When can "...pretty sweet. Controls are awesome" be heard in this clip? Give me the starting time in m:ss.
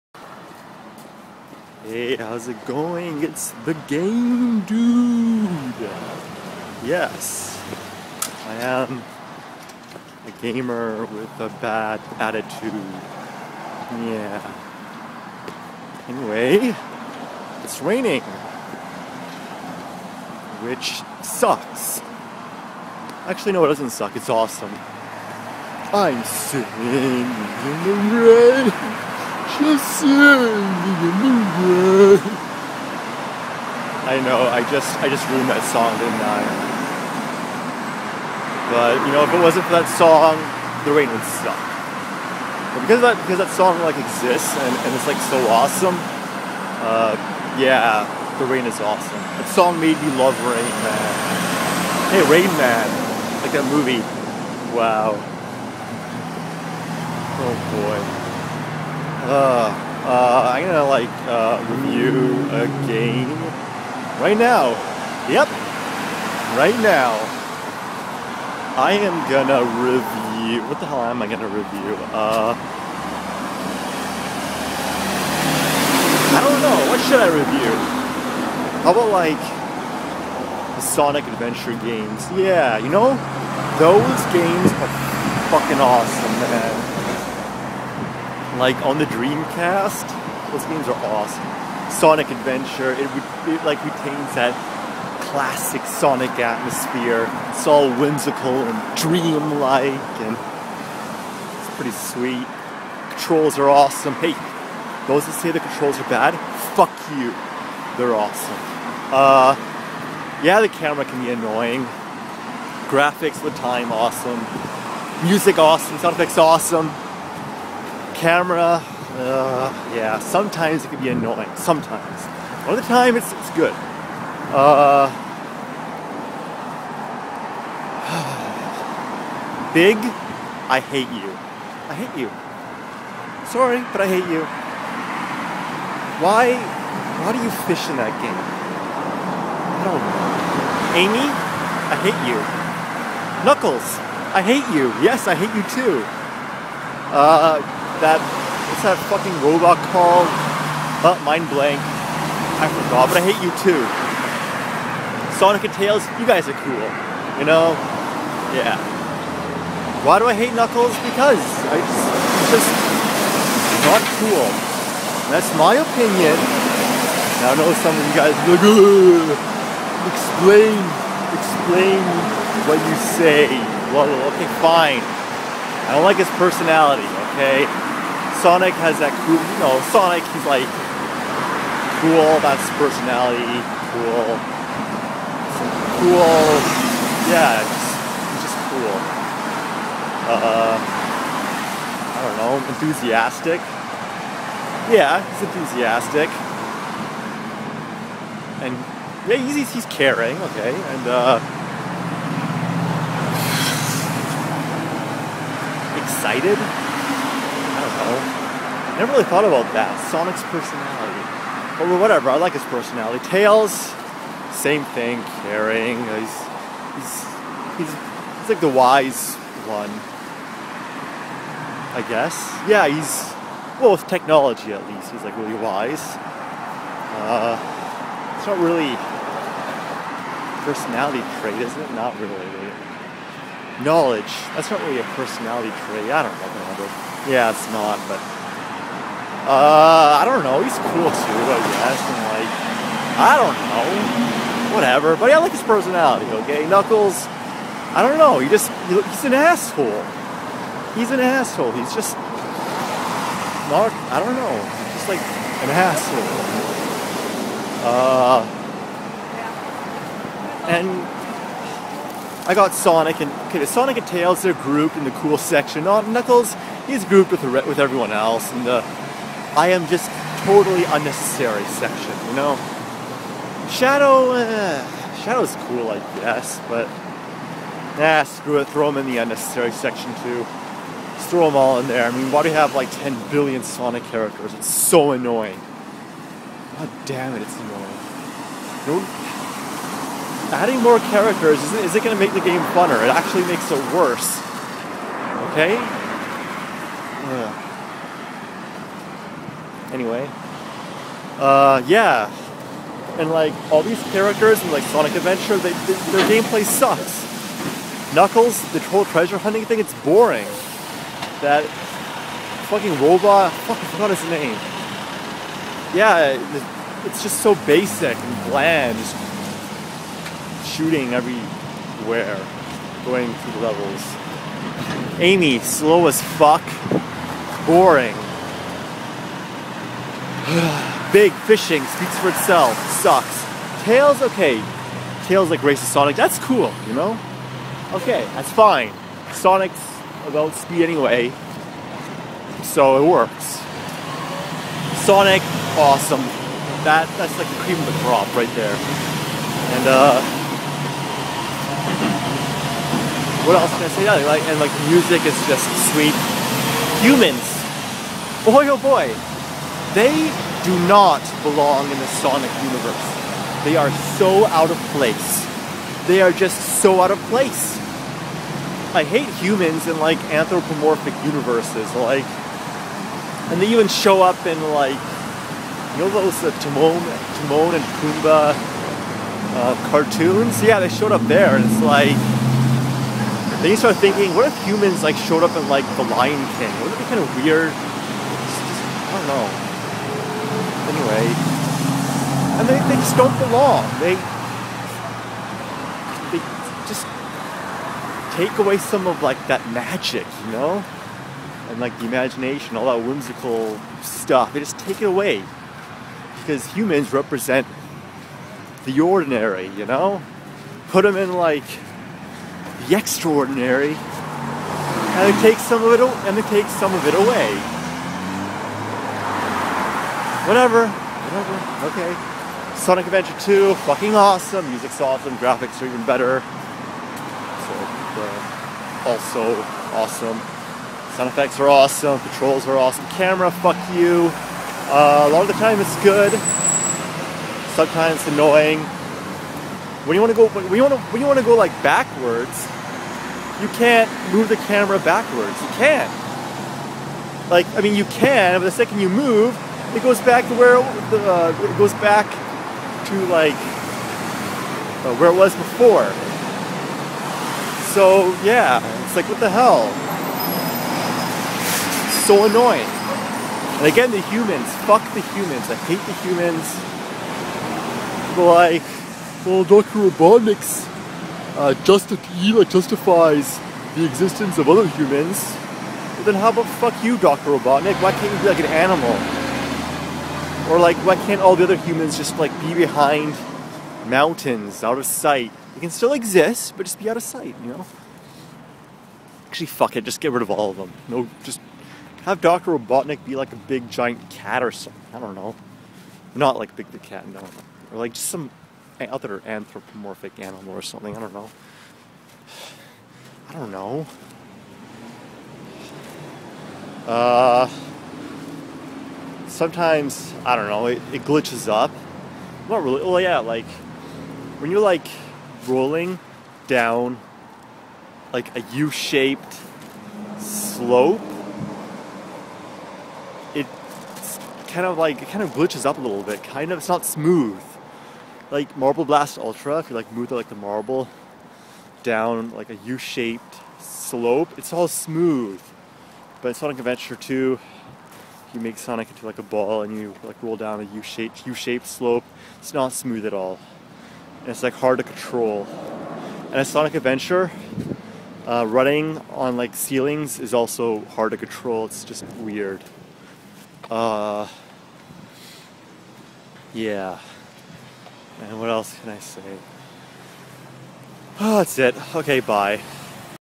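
1:41.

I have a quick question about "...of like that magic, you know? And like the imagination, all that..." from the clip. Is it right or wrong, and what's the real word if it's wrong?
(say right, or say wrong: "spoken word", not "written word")
right.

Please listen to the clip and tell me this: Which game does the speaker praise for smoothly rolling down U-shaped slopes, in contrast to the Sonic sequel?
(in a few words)
Marble Blast Ultra.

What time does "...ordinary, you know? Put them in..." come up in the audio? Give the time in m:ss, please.
6:48.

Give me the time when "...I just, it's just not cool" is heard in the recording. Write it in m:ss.
2:41.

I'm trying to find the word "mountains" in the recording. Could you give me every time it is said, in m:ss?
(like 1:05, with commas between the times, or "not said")
8:04.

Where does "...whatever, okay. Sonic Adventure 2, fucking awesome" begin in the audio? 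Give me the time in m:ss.
7:00.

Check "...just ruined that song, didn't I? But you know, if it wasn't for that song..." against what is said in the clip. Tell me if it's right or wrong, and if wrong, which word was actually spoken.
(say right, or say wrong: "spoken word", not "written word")
right.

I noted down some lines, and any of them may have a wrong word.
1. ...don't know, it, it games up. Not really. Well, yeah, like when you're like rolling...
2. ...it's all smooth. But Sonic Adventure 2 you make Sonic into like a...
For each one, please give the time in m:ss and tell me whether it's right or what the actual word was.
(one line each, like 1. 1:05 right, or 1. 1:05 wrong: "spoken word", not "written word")
1. 8:30 wrong: "glitches", not "games"
2. 8:54 right.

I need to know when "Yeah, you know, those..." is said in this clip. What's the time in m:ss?
1:22.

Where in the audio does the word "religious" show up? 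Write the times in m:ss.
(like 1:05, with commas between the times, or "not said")
not said.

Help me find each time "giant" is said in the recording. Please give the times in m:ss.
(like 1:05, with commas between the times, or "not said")
8:13.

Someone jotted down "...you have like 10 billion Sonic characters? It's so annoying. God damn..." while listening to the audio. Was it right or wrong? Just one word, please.
right.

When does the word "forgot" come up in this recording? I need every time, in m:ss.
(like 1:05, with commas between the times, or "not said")
2:32, 5:13.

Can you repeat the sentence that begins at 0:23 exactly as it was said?
Actually, no, it doesn't suck, it's awesome.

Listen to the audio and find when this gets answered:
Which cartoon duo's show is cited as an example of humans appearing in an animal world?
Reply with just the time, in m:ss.
6:17.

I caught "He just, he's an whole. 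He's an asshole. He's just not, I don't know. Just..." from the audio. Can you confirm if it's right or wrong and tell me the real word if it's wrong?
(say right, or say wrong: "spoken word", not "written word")
wrong: "asshole", not "whole".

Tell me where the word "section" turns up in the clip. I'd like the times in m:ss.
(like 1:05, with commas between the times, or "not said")
4:25, 4:31, 4:39.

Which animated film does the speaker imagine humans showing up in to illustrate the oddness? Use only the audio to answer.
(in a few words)
The Lion King.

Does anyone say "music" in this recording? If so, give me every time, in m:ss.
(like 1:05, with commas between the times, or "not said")
1:55, 5:54, 7:04.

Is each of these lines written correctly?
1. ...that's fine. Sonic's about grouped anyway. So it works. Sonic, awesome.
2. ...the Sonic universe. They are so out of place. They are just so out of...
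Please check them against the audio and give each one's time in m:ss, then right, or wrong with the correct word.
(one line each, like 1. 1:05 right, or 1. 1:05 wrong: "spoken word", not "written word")
1. 5:38 wrong: "speed", not "grouped"
2. 6:01 right.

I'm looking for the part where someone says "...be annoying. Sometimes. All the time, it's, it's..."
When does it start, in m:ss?
2:01.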